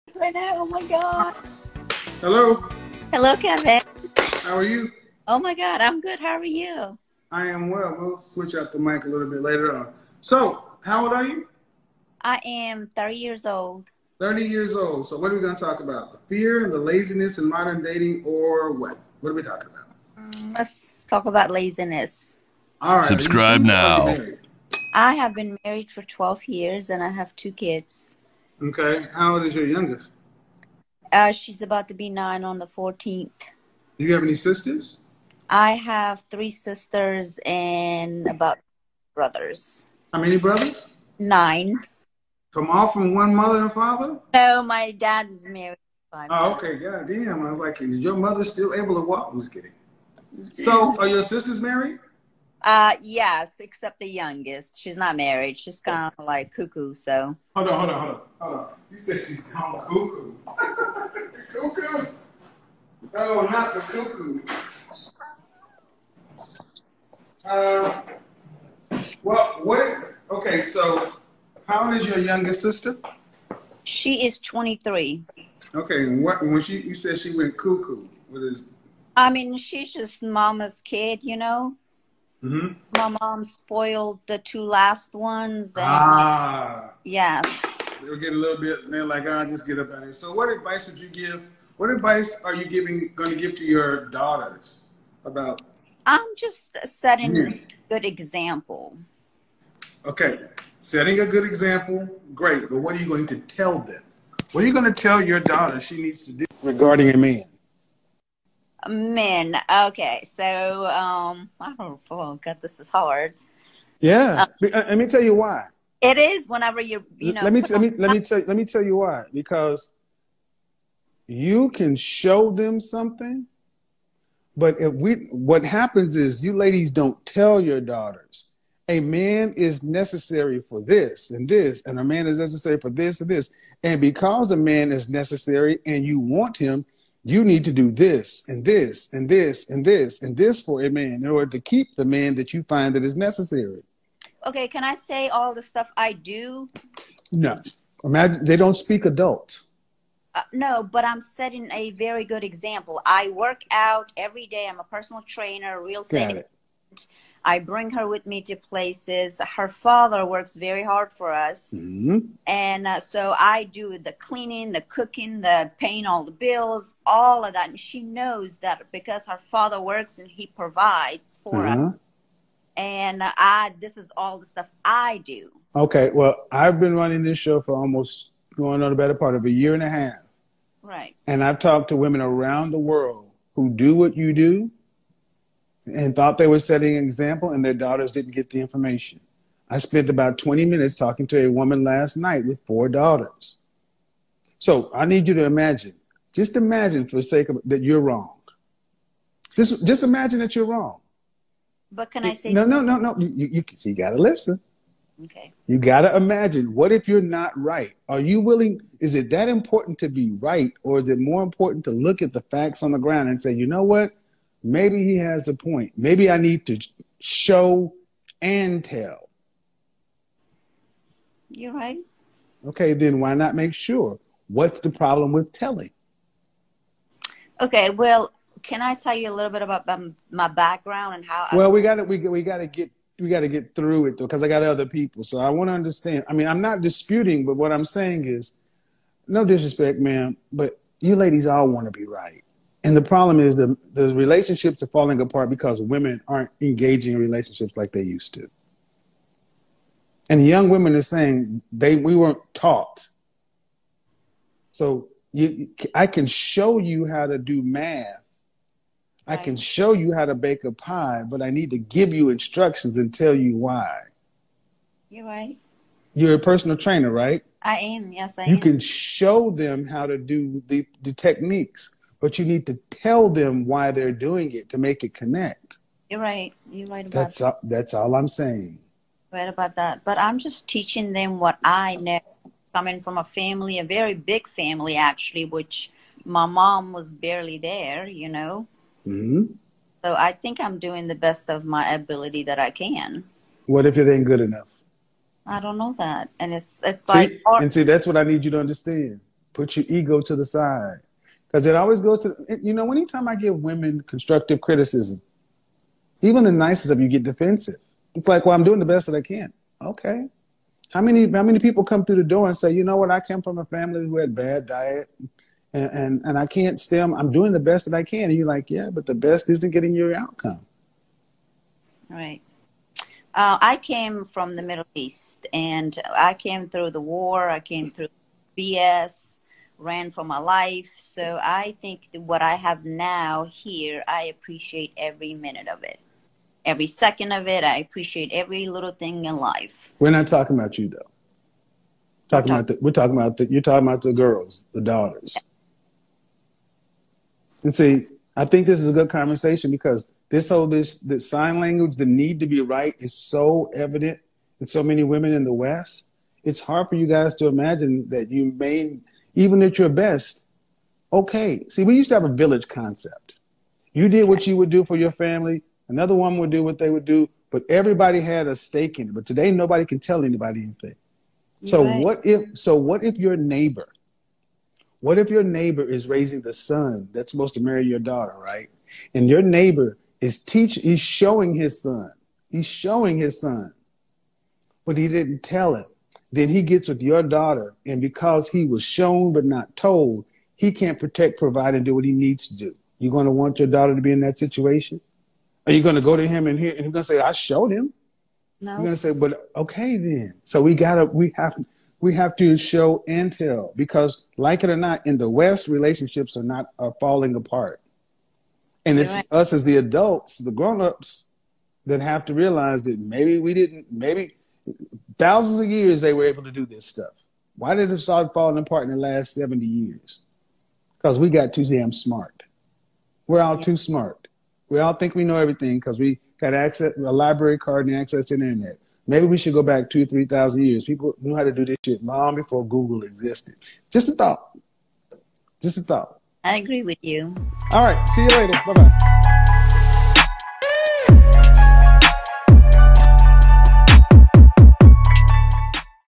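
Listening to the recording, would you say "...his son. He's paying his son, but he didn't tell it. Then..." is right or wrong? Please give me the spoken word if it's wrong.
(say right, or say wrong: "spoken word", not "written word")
wrong: "showing", not "paying".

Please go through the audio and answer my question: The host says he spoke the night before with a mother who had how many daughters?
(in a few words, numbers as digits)
4.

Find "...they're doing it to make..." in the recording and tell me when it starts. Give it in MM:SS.
04:33.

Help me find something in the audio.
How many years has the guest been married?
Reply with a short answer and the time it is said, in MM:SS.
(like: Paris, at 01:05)
12, at 00:26.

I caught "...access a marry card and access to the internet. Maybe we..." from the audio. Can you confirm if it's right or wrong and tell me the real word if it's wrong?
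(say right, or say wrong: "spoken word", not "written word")
wrong: "library", not "marry".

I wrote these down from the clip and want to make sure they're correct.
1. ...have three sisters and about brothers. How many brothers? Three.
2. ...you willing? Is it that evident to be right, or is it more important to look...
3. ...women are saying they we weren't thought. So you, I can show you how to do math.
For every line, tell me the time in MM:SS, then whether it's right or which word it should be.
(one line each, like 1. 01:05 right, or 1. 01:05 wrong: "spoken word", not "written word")
1. 00:35 wrong: "Nine", not "Three"
2. 03:28 wrong: "important", not "evident"
3. 04:10 wrong: "taught", not "thought".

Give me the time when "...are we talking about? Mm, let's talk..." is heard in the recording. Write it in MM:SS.
00:19.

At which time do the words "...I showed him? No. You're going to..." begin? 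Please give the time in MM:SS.
06:37.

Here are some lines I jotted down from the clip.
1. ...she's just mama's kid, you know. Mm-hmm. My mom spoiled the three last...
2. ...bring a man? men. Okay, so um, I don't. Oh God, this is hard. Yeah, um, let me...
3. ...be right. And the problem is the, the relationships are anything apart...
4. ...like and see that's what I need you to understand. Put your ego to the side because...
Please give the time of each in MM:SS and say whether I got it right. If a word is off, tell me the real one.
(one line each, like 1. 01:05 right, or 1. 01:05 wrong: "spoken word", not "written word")
1. 01:19 wrong: "two", not "three"
2. 01:46 wrong: "regarding", not "bring"
3. 04:01 wrong: "falling", not "anything"
4. 04:57 right.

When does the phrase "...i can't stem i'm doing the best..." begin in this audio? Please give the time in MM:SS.
05:16.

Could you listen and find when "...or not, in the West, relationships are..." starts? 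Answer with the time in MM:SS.
06:44.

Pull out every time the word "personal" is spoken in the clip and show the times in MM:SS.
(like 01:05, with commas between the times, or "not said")
02:34, 04:26.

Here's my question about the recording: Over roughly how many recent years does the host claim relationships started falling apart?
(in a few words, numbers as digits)
70.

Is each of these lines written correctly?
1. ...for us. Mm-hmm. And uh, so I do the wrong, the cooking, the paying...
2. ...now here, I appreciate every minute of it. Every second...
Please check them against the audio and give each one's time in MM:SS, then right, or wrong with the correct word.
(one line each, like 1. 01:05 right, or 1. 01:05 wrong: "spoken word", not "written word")
1. 02:41 wrong: "cleaning", not "wrong"
2. 05:32 right.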